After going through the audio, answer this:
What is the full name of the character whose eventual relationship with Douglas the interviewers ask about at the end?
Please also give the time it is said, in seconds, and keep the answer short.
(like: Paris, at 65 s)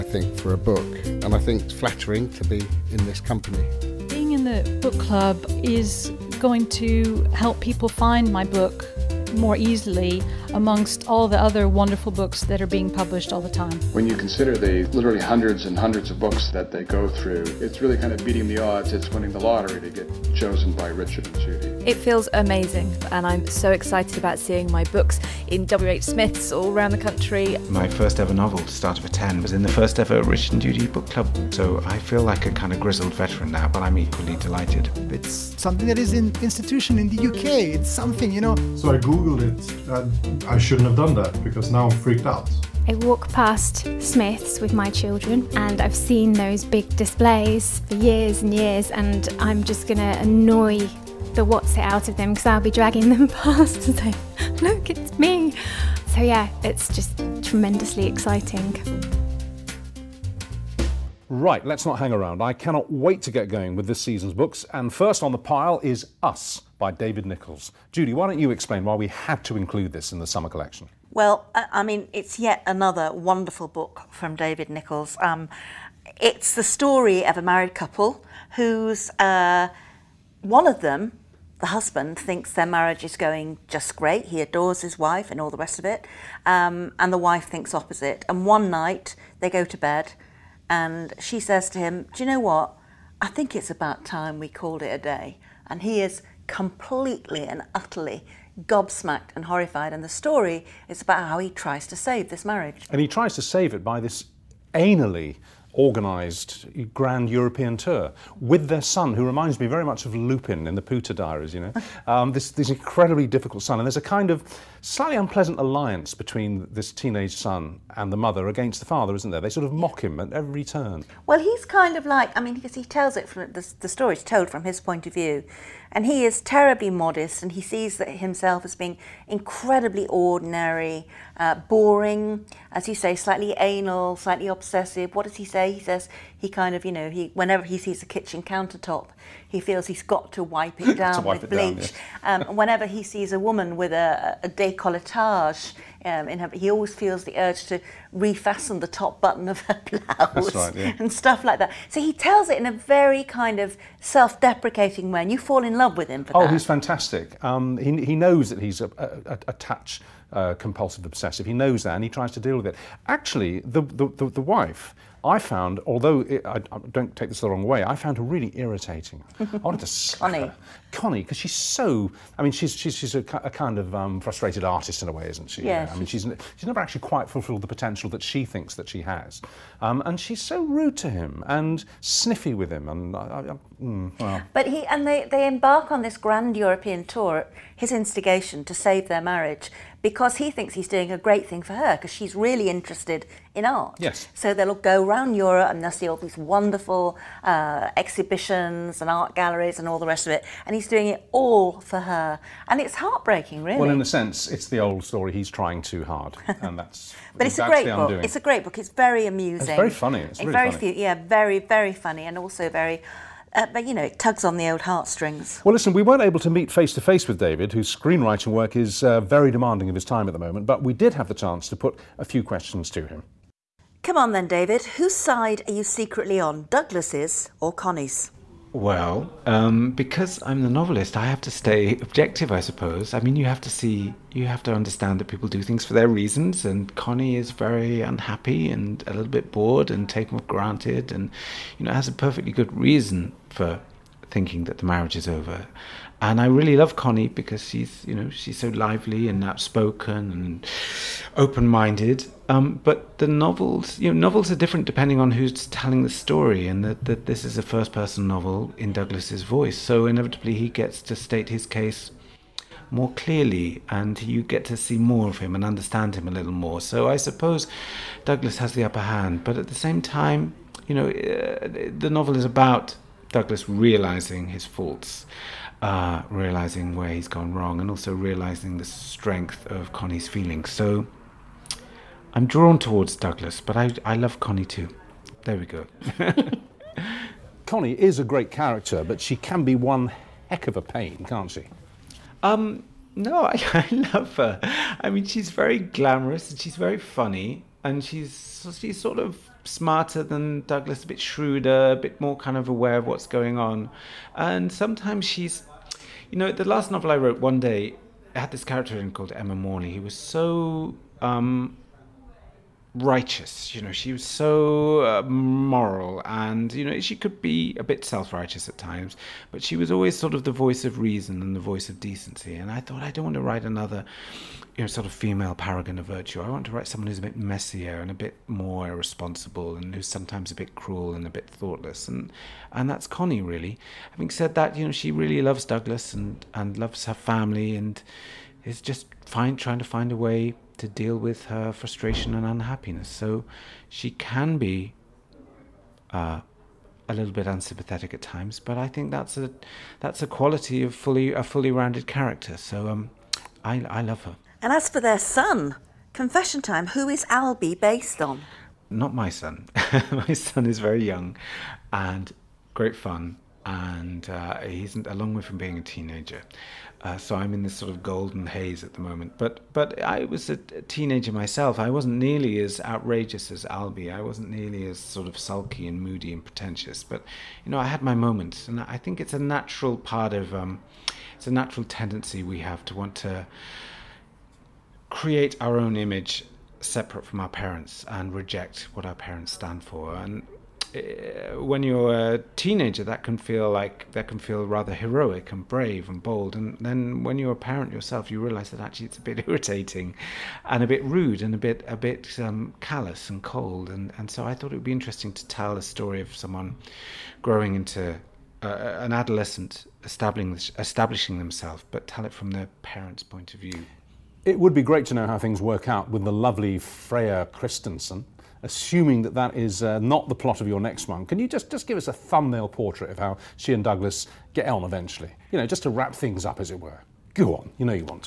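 Freya Christensen, at 416 s.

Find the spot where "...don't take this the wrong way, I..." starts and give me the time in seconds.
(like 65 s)
166 s.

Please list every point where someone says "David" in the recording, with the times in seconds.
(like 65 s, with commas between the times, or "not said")
66 s, 74 s, 217 s, 224 s.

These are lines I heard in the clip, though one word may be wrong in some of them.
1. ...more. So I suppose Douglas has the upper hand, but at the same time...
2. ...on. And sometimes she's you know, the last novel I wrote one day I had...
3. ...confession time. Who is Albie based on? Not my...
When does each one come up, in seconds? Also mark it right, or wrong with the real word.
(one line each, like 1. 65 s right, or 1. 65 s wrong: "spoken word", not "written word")
1. 266 s right
2. 303 s right
3. 356 s right.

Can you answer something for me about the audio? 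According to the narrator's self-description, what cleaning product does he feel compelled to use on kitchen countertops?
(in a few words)
bleach.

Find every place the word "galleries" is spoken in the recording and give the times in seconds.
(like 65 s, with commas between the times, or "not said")
199 s.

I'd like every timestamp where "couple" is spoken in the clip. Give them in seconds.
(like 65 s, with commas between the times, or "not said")
77 s.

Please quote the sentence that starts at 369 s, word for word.
But but I was a teenager myself.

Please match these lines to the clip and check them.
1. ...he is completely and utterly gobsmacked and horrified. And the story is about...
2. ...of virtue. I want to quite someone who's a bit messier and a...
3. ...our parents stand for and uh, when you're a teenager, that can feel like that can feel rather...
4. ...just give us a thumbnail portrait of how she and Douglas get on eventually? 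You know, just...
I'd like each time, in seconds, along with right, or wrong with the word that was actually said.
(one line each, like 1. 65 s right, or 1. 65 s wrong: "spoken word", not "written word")
1. 95 s right
2. 325 s wrong: "write", not "quite"
3. 389 s right
4. 421 s right.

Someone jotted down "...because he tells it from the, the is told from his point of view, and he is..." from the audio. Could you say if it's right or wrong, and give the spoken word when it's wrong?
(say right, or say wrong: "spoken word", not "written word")
right.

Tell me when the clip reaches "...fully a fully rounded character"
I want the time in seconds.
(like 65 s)
350 s.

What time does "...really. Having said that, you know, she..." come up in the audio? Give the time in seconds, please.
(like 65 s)
333 s.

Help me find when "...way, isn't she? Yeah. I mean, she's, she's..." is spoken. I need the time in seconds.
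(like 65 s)
175 s.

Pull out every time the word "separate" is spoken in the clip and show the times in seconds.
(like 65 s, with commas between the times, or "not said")
386 s.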